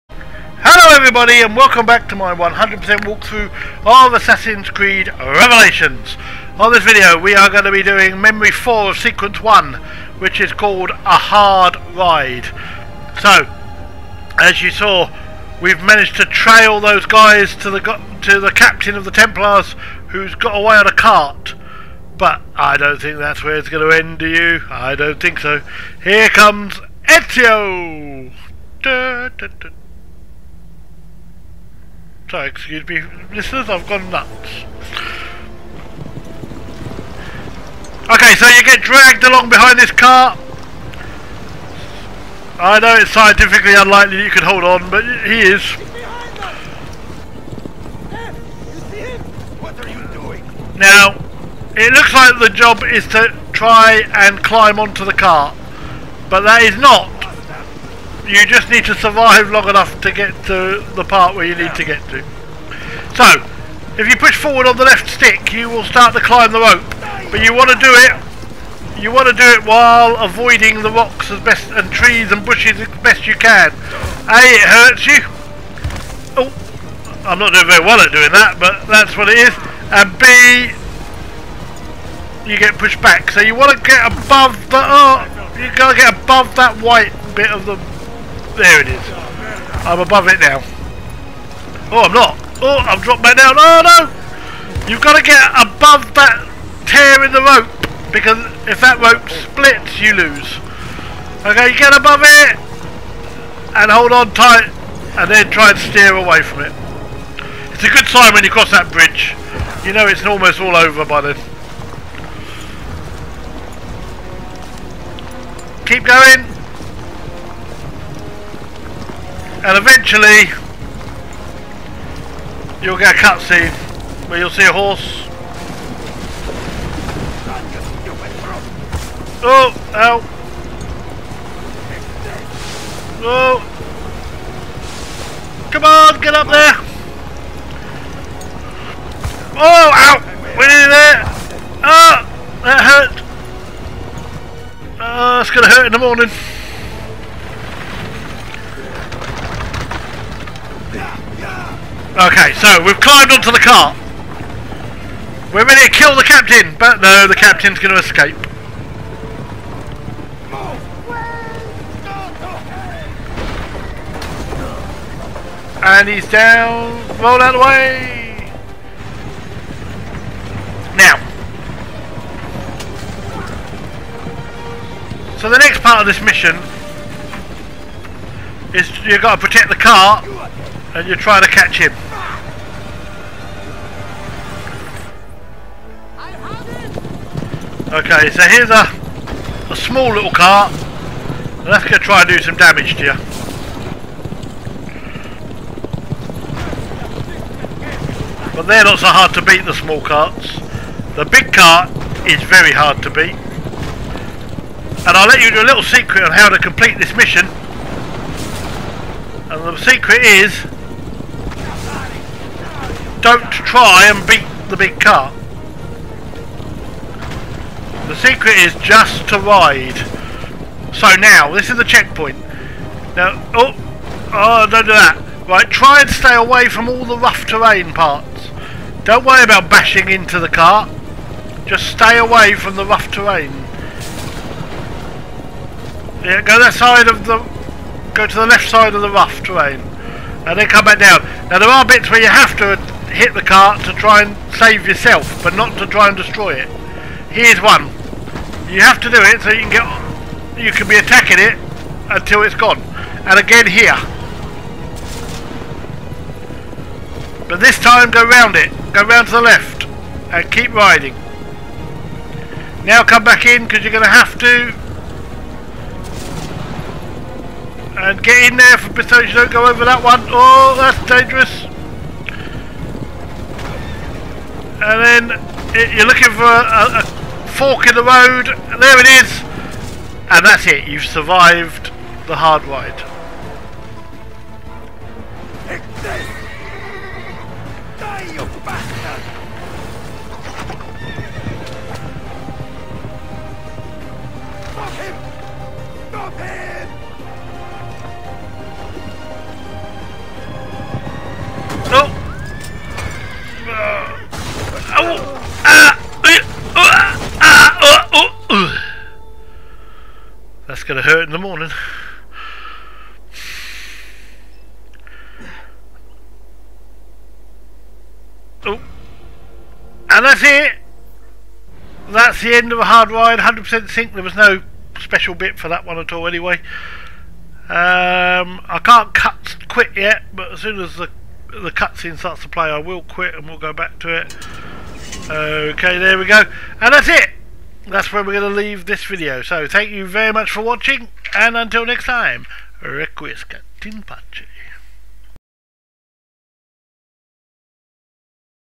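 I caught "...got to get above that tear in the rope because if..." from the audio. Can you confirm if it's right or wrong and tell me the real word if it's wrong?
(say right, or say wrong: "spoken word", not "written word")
right.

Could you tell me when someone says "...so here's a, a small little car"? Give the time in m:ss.
3:08.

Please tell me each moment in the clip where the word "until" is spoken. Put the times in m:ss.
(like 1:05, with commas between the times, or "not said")
4:12, 5:41.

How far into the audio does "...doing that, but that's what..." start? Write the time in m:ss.
1:18.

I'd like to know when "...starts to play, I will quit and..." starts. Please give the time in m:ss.
5:32.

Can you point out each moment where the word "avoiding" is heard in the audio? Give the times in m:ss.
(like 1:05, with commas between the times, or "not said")
1:10.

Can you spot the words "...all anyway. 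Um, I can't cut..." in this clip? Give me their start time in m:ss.
5:26.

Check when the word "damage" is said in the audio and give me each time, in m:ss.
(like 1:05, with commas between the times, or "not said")
3:12.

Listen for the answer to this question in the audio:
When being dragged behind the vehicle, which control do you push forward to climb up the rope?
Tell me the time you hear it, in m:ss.
1:04.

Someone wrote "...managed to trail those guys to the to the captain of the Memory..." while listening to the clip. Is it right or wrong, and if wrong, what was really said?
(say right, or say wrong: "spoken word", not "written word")
wrong: "Templars", not "Memory".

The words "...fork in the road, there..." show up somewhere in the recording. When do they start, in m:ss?
4:37.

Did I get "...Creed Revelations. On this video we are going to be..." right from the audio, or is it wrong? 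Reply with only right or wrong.
right.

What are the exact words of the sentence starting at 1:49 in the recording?
You know it's almost all over by then.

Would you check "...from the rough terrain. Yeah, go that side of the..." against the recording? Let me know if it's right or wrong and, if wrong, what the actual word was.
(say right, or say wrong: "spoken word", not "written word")
right.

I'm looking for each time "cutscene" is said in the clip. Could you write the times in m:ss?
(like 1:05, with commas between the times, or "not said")
2:03, 5:31.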